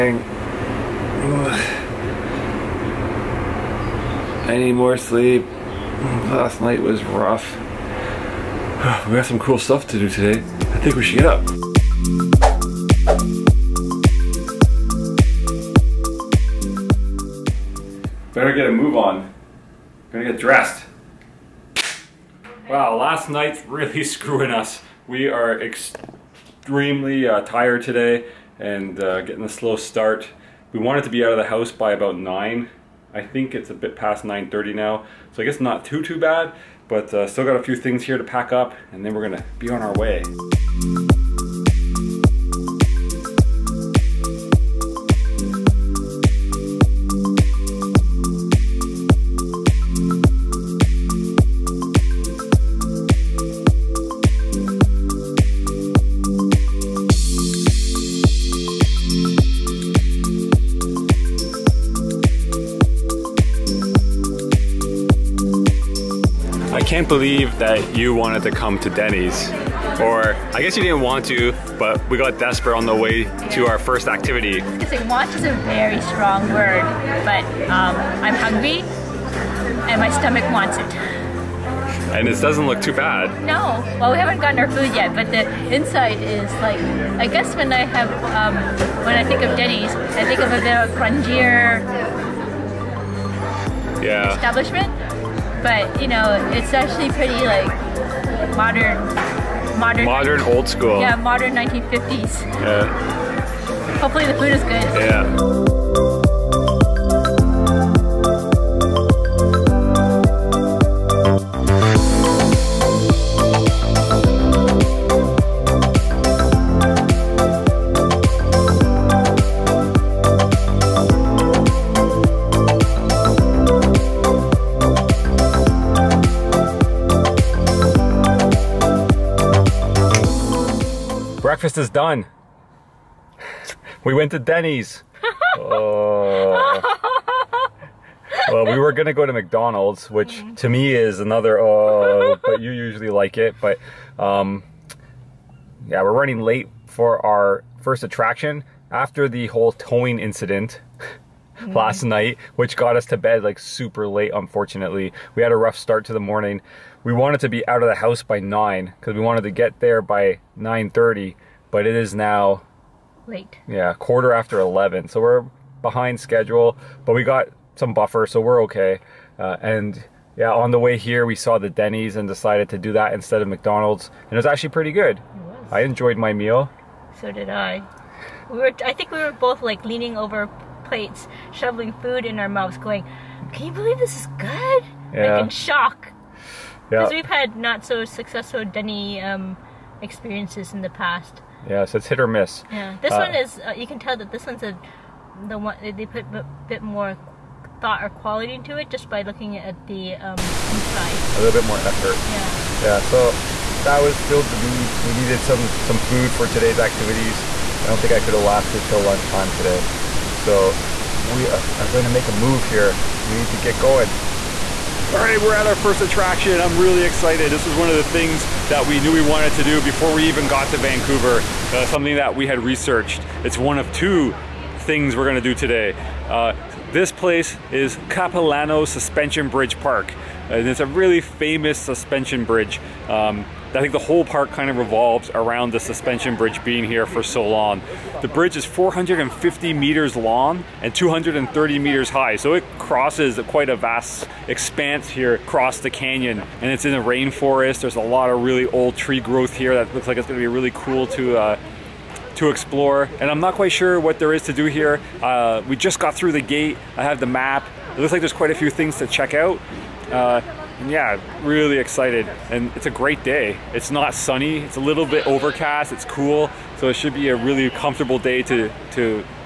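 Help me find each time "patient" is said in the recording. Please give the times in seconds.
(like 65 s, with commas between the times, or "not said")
not said.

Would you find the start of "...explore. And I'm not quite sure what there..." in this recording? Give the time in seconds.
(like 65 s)
252 s.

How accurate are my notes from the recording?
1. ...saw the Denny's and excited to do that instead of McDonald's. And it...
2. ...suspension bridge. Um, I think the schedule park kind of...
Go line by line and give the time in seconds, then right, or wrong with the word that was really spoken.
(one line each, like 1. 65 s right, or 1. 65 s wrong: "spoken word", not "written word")
1. 171 s wrong: "decided", not "excited"
2. 231 s wrong: "whole", not "schedule".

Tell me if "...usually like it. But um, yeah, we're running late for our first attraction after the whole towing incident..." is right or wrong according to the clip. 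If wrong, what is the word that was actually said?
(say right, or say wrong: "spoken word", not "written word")
right.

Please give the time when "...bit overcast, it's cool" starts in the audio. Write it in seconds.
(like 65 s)
265 s.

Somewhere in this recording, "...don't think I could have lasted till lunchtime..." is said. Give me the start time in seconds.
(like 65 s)
207 s.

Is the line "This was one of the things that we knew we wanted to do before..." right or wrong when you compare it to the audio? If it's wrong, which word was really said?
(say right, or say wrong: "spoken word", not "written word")
right.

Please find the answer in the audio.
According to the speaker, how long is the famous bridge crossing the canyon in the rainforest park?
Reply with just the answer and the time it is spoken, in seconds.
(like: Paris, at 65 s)
450 meters, at 238 s.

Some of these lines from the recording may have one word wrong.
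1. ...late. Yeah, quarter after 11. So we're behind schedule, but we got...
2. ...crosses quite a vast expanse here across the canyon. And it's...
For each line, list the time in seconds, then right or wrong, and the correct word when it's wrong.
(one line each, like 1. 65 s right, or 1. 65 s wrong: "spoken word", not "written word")
1. 163 s right
2. 242 s right.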